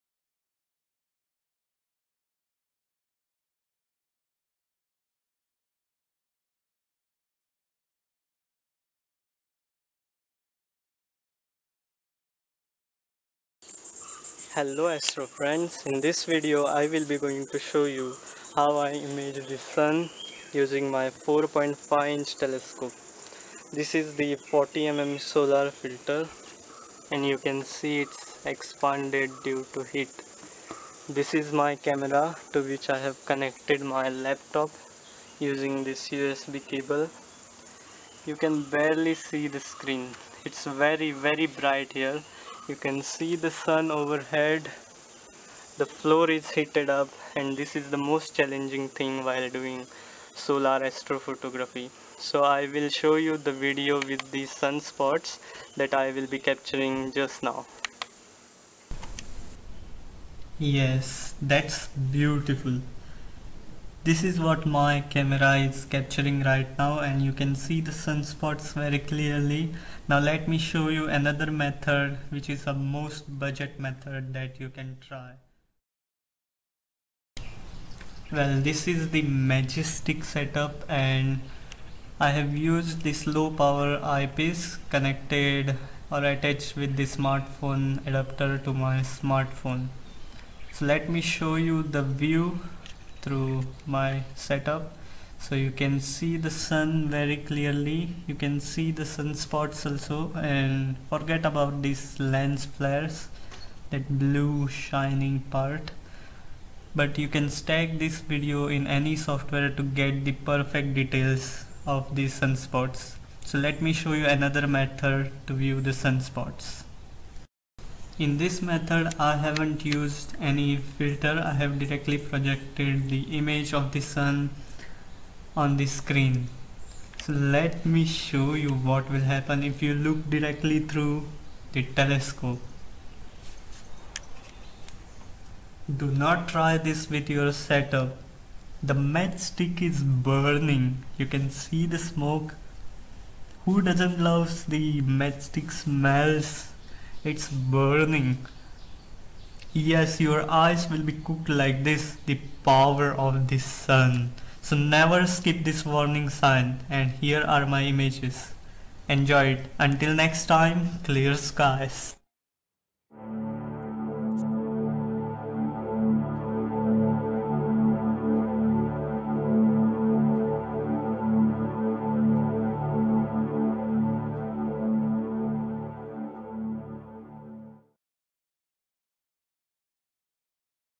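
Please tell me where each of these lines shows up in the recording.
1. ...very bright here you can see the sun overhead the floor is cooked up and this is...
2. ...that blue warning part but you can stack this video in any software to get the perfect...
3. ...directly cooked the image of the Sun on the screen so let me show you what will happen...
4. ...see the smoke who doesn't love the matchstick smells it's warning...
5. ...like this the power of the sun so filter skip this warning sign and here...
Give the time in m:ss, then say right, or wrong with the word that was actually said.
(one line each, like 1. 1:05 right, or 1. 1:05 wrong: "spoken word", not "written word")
1. 0:41 wrong: "heated", not "cooked"
2. 1:43 wrong: "shining", not "warning"
3. 2:01 wrong: "projected", not "cooked"
4. 2:21 wrong: "burning", not "warning"
5. 2:31 wrong: "never", not "filter".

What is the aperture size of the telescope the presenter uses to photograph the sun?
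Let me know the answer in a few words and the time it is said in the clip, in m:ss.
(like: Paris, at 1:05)
4.5 inch, at 0:21.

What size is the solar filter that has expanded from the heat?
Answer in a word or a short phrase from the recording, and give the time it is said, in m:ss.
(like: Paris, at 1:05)
40 mm, at 0:24.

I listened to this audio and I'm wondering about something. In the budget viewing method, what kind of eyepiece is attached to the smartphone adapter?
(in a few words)
low power eyepiece.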